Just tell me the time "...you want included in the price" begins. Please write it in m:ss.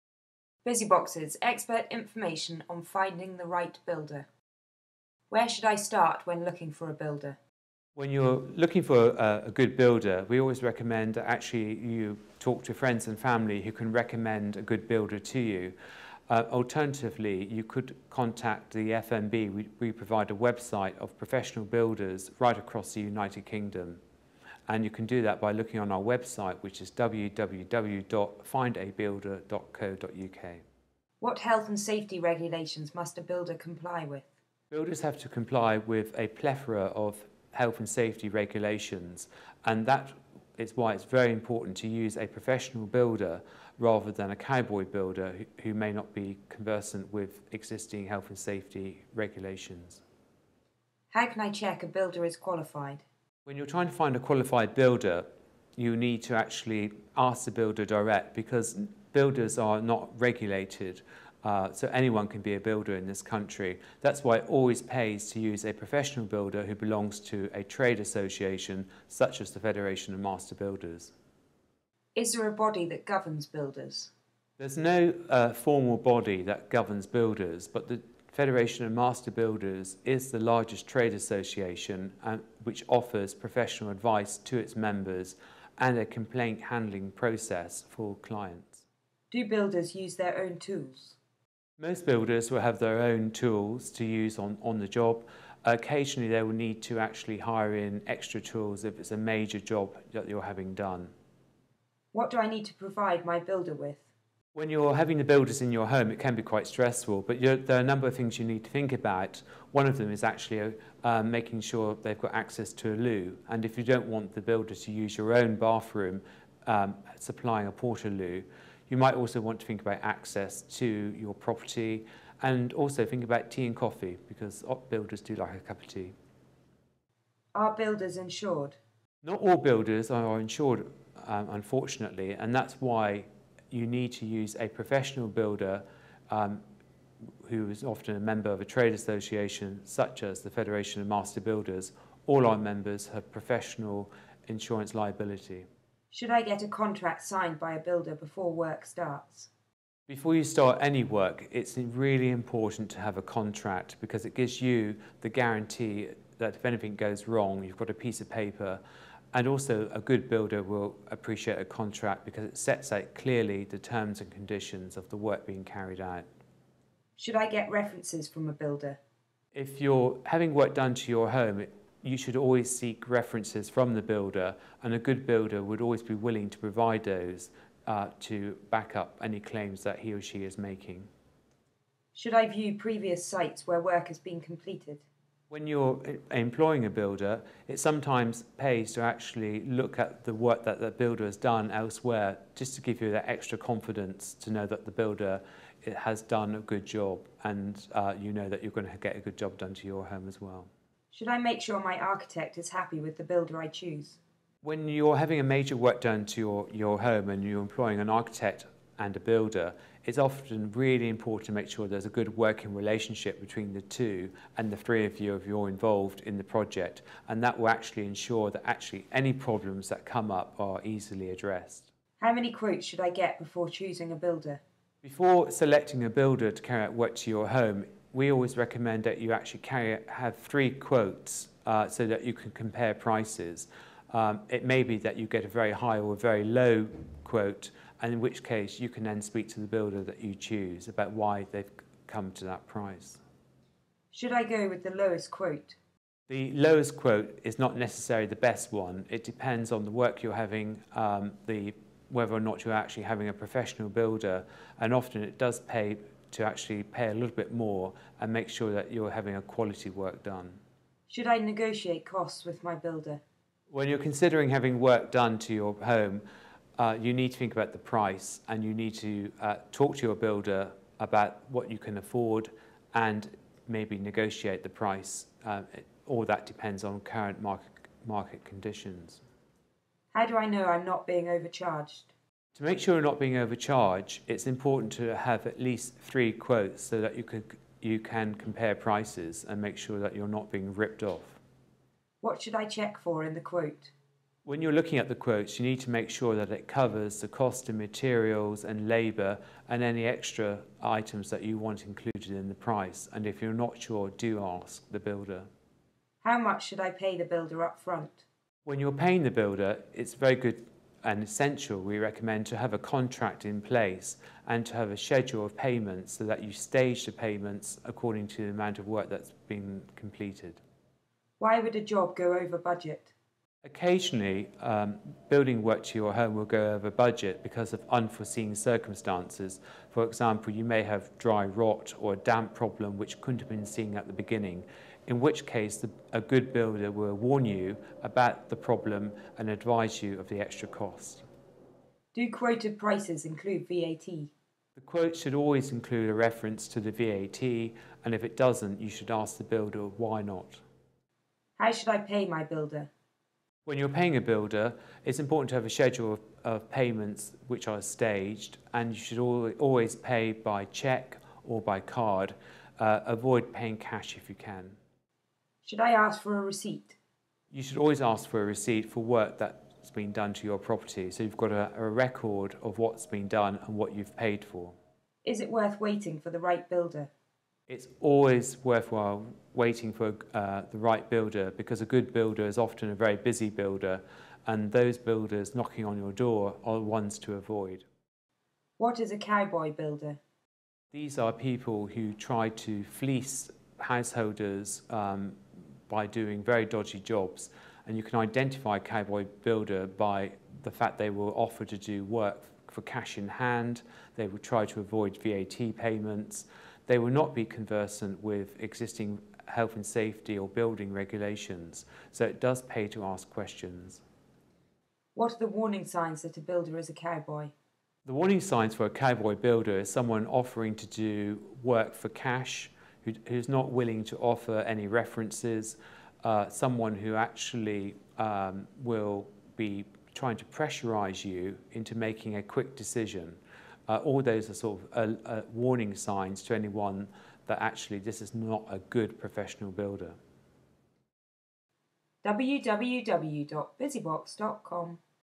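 5:01.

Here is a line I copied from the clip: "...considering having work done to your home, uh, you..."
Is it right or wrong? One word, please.
right.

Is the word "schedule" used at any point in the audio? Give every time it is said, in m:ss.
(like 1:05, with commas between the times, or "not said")
5:14, 5:55.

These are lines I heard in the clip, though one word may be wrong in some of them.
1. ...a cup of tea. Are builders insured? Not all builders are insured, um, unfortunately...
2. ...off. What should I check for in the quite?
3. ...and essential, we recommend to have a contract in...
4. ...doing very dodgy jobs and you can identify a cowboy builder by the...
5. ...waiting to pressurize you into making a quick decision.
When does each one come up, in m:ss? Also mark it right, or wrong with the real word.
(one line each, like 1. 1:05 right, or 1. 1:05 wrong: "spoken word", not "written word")
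1. 2:05 right
2. 4:51 wrong: "quote", not "quite"
3. 5:11 right
4. 6:36 right
5. 7:10 wrong: "trying", not "waiting".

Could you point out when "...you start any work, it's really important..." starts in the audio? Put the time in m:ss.
2:30.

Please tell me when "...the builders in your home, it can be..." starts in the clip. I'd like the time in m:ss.
1:45.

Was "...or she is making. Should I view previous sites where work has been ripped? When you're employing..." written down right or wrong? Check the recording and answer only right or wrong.
wrong.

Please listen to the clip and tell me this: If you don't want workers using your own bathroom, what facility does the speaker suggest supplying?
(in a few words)
porta loo.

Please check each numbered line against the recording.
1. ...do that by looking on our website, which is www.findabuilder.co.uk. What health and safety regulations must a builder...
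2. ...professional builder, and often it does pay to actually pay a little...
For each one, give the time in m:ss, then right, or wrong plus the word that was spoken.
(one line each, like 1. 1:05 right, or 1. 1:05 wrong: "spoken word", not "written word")
1. 0:25 right
2. 4:13 right.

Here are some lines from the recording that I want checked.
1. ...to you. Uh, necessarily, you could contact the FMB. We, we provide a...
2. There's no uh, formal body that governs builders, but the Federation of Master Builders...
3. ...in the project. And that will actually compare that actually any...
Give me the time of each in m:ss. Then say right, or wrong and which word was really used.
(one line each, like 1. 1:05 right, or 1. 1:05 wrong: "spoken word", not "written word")
1. 0:15 wrong: "alternatively", not "necessarily"
2. 1:14 right
3. 3:36 wrong: "ensure", not "compare".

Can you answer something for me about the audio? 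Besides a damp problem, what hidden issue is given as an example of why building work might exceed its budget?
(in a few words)
dry rot.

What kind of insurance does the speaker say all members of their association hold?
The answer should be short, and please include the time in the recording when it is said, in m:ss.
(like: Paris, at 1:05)
professional insurance liability, at 2:23.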